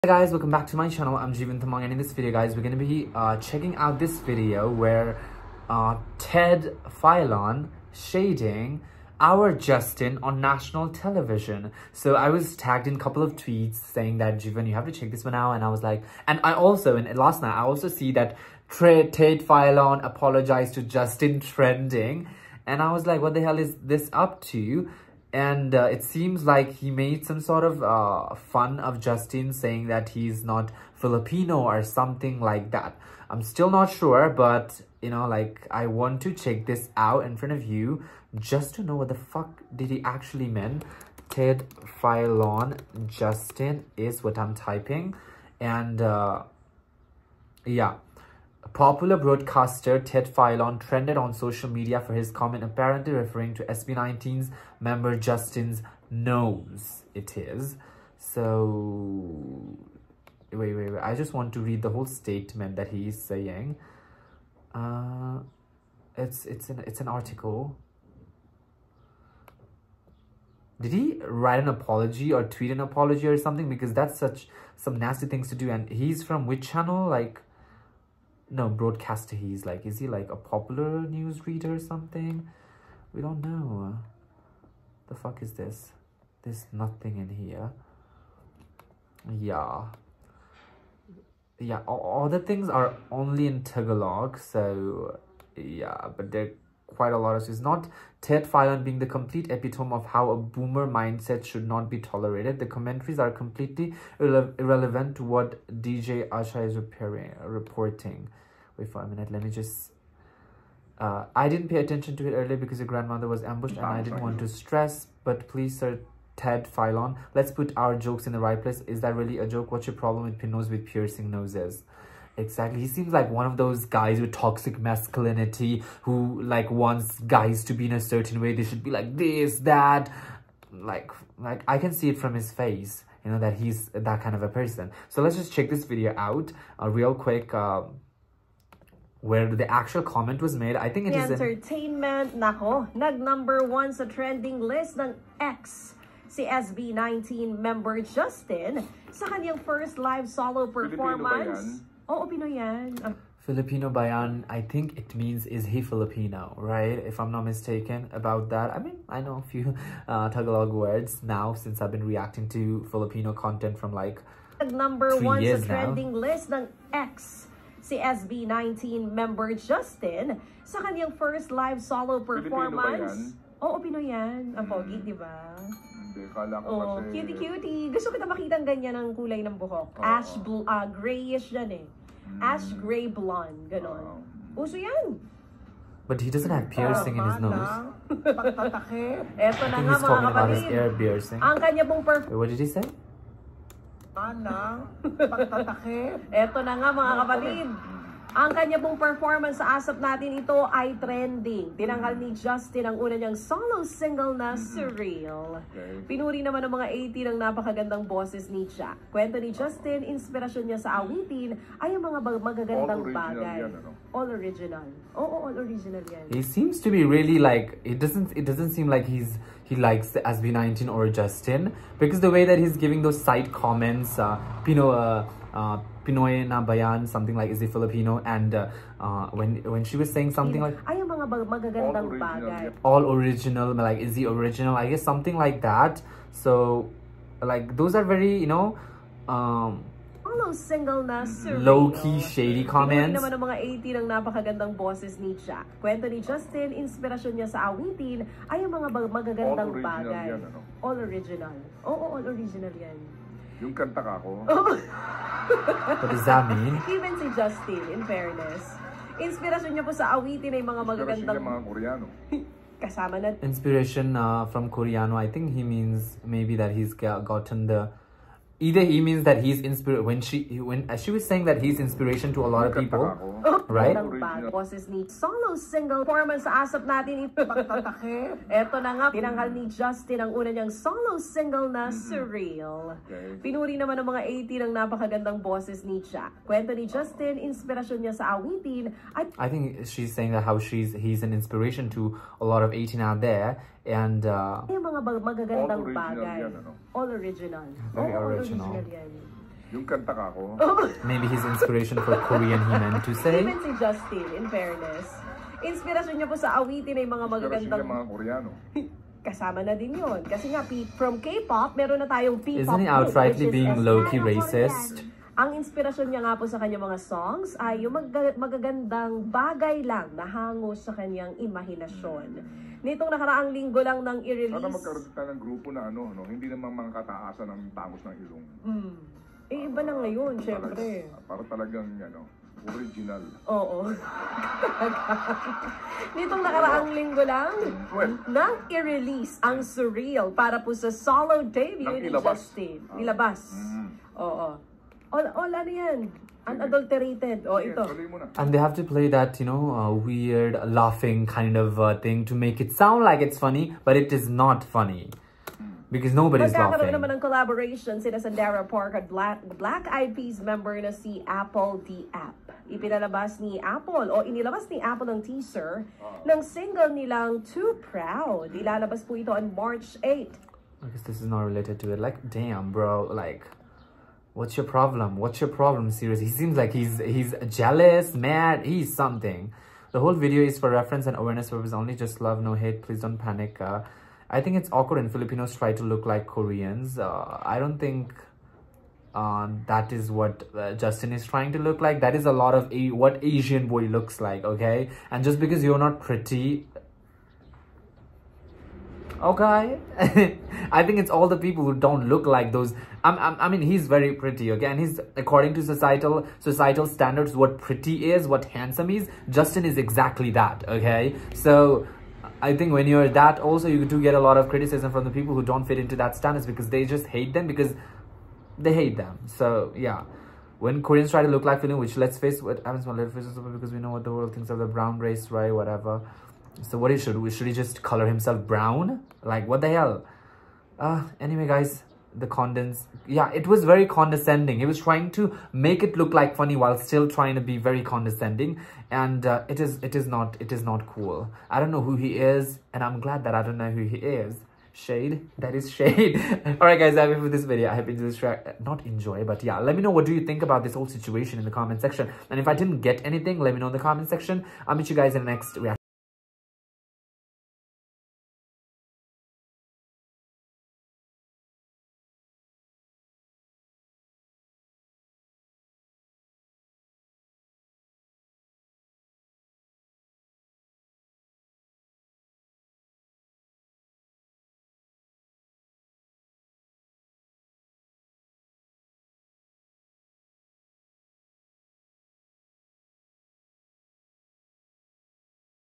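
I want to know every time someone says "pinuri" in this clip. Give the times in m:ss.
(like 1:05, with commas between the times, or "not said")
3:26, 4:43.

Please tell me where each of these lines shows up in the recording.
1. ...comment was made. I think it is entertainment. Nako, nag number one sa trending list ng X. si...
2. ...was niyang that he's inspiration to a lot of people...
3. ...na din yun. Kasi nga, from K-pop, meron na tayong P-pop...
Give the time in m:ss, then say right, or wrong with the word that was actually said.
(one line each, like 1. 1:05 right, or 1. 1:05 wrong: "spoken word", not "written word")
1. 2:20 right
2. 4:31 wrong: "saying", not "niyang"
3. 5:09 right.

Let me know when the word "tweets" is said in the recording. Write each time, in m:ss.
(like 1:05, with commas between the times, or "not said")
0:13, 1:12.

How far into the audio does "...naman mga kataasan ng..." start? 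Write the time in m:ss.
5:26.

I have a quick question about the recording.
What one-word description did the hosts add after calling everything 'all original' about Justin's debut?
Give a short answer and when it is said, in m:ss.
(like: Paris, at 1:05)
Unadulterated, at 5:46.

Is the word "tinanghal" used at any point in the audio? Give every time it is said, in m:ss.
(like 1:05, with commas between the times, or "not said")
3:21, 4:39.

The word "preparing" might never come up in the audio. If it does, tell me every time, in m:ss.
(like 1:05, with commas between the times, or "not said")
not said.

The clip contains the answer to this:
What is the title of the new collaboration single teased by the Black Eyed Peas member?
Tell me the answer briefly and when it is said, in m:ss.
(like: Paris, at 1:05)
Too Proud, at 6:07.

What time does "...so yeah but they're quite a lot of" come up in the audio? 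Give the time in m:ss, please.
1:34.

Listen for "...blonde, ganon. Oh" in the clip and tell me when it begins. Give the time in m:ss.
3:03.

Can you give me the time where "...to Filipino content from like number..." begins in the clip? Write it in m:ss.
2:42.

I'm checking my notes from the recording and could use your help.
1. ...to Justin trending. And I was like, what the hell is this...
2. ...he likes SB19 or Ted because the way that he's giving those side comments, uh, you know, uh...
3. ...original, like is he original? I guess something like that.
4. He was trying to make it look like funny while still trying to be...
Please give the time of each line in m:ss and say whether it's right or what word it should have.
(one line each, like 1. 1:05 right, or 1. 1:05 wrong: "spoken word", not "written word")
1. 0:20 right
2. 3:39 wrong: "Justin", not "Ted"
3. 3:53 right
4. 7:14 right.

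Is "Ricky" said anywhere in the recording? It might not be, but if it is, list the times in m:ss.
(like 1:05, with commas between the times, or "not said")
not said.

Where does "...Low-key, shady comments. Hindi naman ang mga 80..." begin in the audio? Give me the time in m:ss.
4:01.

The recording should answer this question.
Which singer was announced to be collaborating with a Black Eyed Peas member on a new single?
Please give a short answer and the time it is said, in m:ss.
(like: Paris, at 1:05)
Sandara Park, at 5:58.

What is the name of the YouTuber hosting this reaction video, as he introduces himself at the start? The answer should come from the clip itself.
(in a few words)
Jeevan Tamang.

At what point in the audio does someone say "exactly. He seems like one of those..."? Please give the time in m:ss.
2:02.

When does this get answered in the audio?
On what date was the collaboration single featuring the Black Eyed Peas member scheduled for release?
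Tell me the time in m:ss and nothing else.
6:09.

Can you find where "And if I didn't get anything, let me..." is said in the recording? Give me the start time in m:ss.
7:32.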